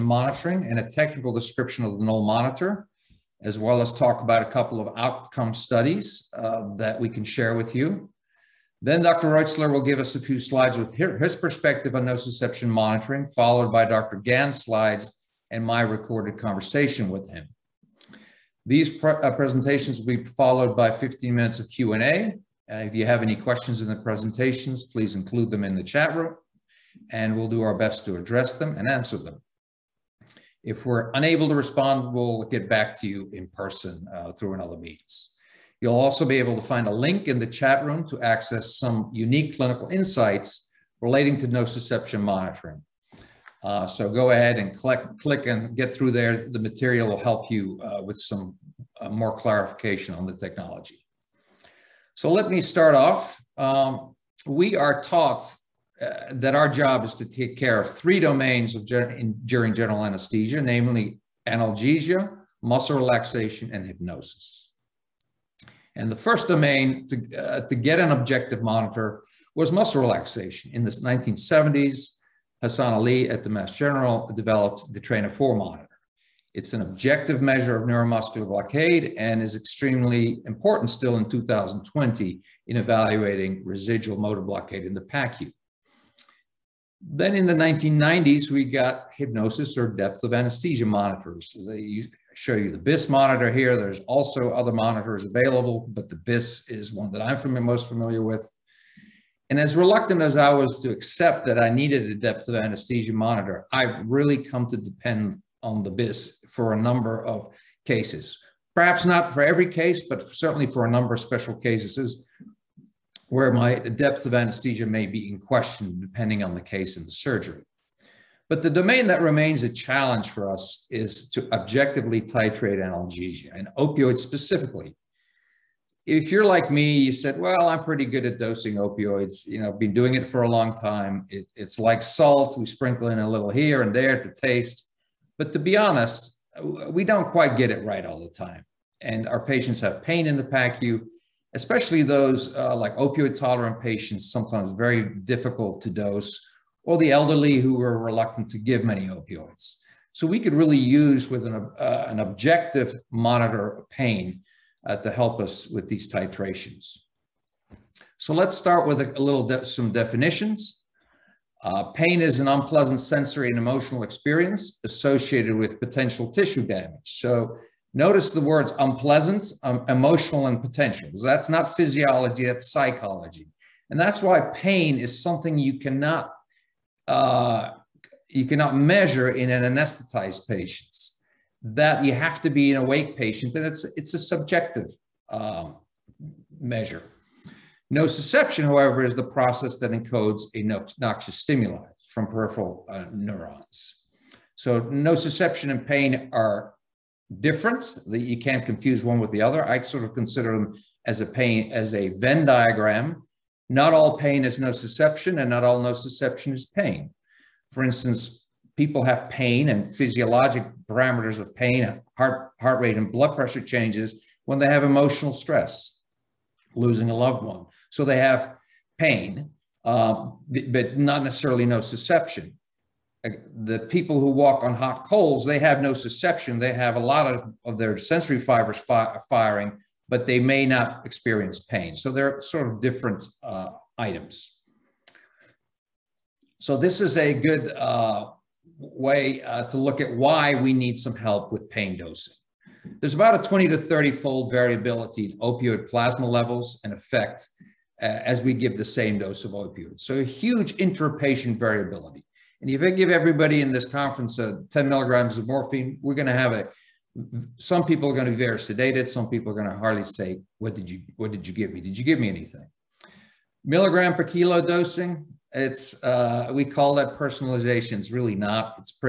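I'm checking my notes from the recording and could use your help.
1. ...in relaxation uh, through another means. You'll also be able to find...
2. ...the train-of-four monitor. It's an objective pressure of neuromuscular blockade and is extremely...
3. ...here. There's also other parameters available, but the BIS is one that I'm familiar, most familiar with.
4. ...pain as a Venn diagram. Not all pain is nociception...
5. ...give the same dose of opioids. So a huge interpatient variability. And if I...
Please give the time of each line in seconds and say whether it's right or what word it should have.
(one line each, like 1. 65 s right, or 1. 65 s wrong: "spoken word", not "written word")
1. 33 s wrong: "person", not "relaxation"
2. 74 s wrong: "measure", not "pressure"
3. 93 s wrong: "monitors", not "parameters"
4. 201 s right
5. 248 s right.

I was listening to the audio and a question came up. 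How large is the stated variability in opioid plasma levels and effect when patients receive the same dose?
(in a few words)
20 to 30 fold.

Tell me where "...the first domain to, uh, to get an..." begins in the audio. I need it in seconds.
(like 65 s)
66 s.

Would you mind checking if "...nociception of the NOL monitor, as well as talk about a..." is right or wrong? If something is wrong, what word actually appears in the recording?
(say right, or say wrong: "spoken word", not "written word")
wrong: "description", not "nociception".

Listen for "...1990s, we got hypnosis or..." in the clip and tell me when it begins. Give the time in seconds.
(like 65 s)
87 s.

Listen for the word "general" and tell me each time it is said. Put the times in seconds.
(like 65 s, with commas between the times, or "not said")
59 s, 73 s.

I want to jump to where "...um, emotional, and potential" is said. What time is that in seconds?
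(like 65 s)
169 s.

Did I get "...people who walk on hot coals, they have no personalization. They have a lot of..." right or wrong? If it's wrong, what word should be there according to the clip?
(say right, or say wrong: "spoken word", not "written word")
wrong: "nociception", not "personalization".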